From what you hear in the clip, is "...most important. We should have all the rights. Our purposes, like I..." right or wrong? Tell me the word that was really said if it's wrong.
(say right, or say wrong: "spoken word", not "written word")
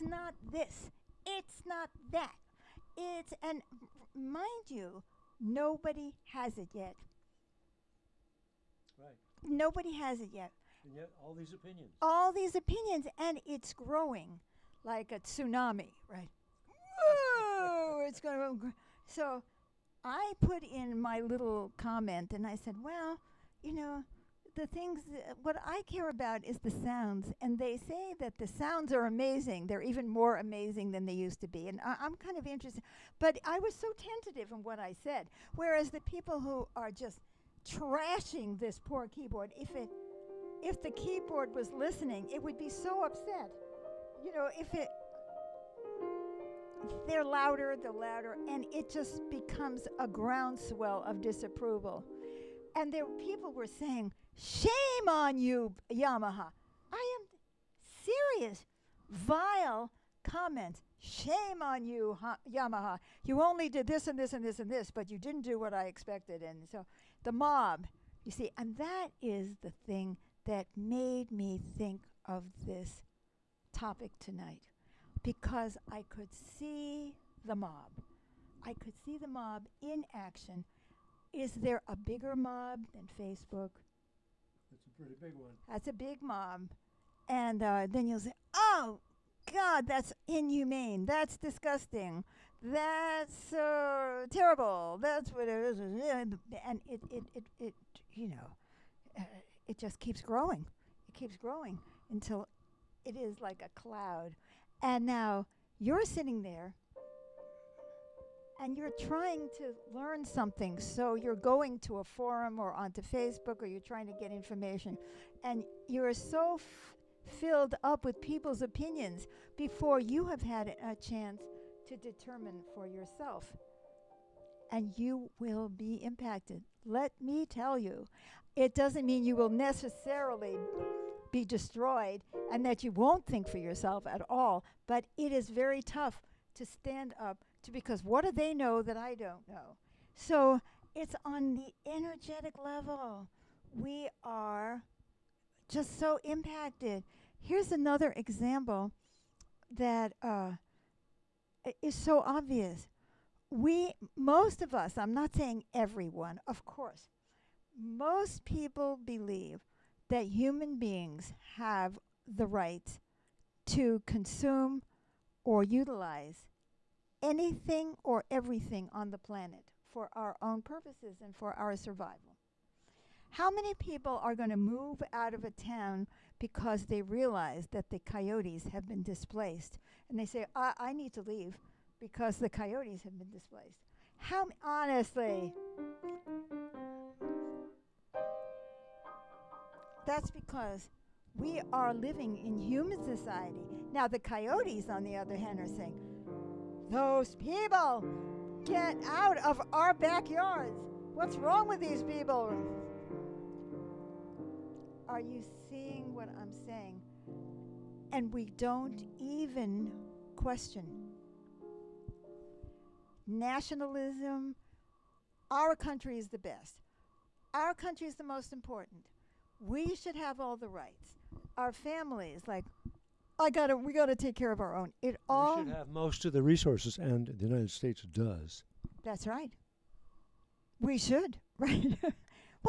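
wrong: "families", not "purposes".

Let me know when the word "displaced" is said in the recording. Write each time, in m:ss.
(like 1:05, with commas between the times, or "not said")
2:59, 3:03.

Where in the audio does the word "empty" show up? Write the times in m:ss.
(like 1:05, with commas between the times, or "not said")
not said.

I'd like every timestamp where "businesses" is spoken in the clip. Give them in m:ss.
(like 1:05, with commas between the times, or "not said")
not said.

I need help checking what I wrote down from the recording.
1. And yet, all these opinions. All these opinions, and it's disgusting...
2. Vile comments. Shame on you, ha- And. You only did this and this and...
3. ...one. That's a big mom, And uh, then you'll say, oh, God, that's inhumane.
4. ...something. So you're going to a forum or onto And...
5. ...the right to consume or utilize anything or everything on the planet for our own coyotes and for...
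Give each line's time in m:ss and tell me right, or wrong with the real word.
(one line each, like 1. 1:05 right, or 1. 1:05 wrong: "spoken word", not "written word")
1. 0:10 wrong: "growing", not "disgusting"
2. 0:59 wrong: "Yamaha", not "And"
3. 1:25 right
4. 1:50 wrong: "Facebook", not "And"
5. 2:42 wrong: "purposes", not "coyotes".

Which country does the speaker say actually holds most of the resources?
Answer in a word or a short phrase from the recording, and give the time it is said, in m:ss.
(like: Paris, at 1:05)
United States, at 3:47.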